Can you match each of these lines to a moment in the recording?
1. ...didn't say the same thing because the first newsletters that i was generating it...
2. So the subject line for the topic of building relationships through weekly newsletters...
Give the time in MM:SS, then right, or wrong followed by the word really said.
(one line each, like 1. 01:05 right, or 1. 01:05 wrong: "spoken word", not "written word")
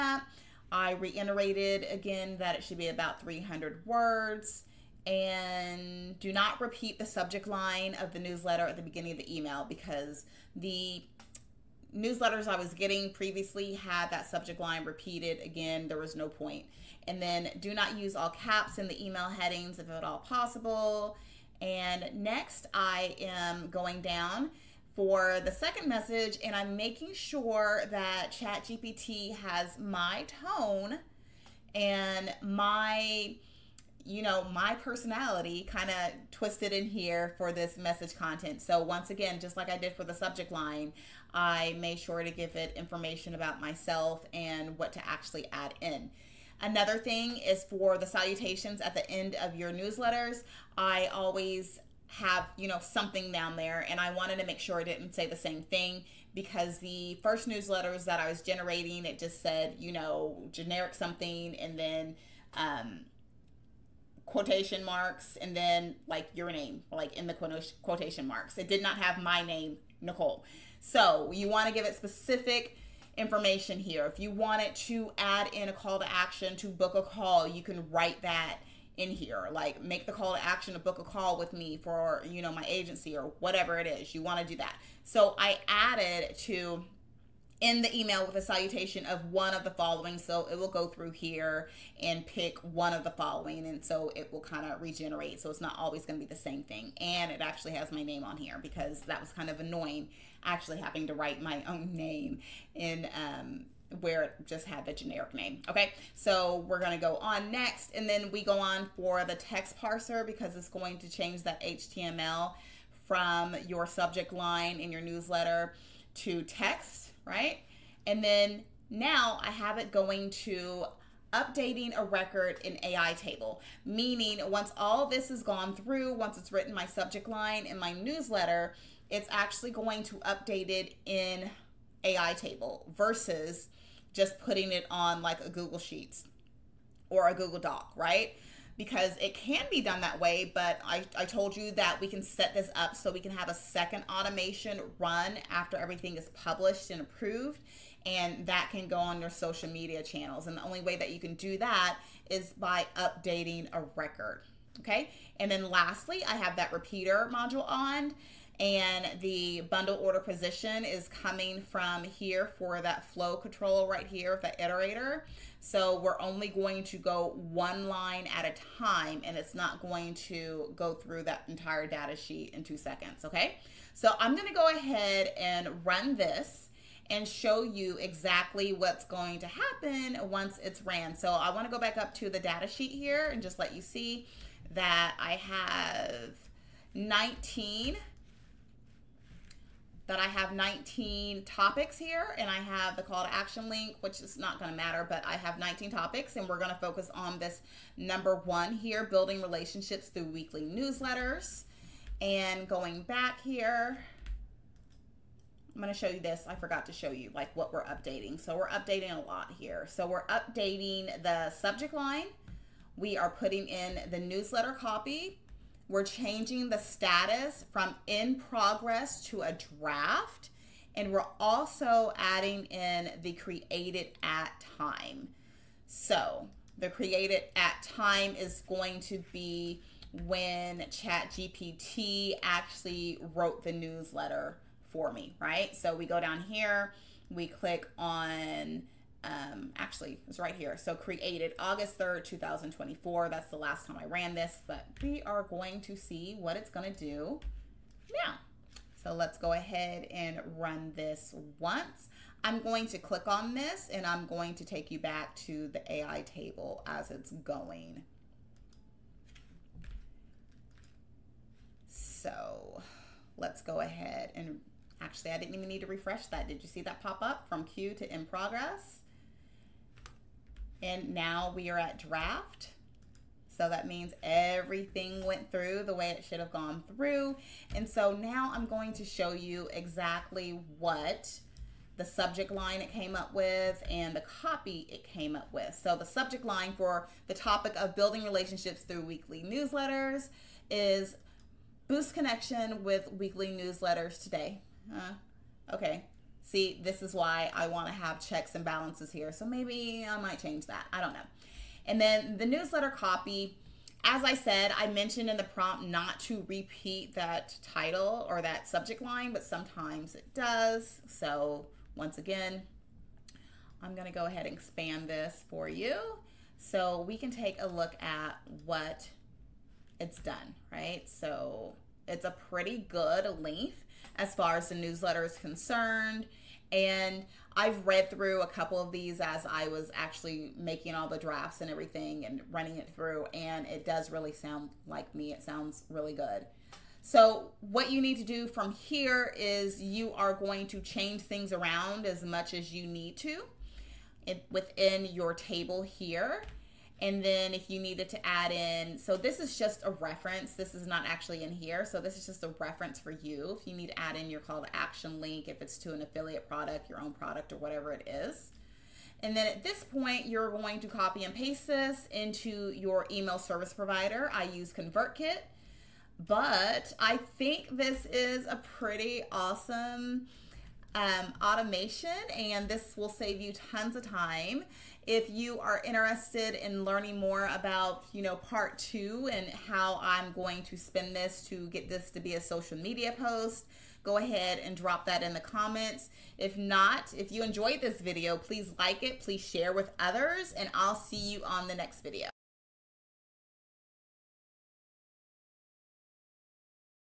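1. 00:54 right
2. 04:45 right.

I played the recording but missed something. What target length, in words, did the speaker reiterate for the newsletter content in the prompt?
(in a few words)
300.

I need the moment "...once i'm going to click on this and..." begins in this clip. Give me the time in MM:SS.
04:11.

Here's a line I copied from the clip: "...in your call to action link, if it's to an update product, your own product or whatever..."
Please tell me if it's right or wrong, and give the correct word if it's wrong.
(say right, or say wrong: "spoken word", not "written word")
wrong: "affiliate", not "update".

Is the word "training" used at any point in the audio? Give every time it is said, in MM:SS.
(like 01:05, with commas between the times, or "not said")
not said.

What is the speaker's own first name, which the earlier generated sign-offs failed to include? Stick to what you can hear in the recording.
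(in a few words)
Nachole.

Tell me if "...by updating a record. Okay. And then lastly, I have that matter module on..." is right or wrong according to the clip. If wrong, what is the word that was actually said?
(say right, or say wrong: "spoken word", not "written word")
wrong: "repeater", not "matter".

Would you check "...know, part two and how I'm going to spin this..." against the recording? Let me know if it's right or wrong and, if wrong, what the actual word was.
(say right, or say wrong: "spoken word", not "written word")
right.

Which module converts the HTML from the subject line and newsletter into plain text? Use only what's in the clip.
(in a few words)
text parser.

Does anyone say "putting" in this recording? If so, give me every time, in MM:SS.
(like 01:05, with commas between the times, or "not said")
02:14, 03:33.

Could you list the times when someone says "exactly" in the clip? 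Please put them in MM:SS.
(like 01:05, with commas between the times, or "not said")
02:57, 04:39.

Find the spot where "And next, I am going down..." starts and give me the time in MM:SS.
00:21.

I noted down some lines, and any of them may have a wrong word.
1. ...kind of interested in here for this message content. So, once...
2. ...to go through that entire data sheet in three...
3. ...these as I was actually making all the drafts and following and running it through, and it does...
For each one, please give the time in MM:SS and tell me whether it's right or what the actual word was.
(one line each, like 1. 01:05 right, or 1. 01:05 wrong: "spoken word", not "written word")
1. 00:35 wrong: "twisted", not "interested"
2. 02:50 wrong: "two", not "three"
3. 05:28 wrong: "everything", not "following".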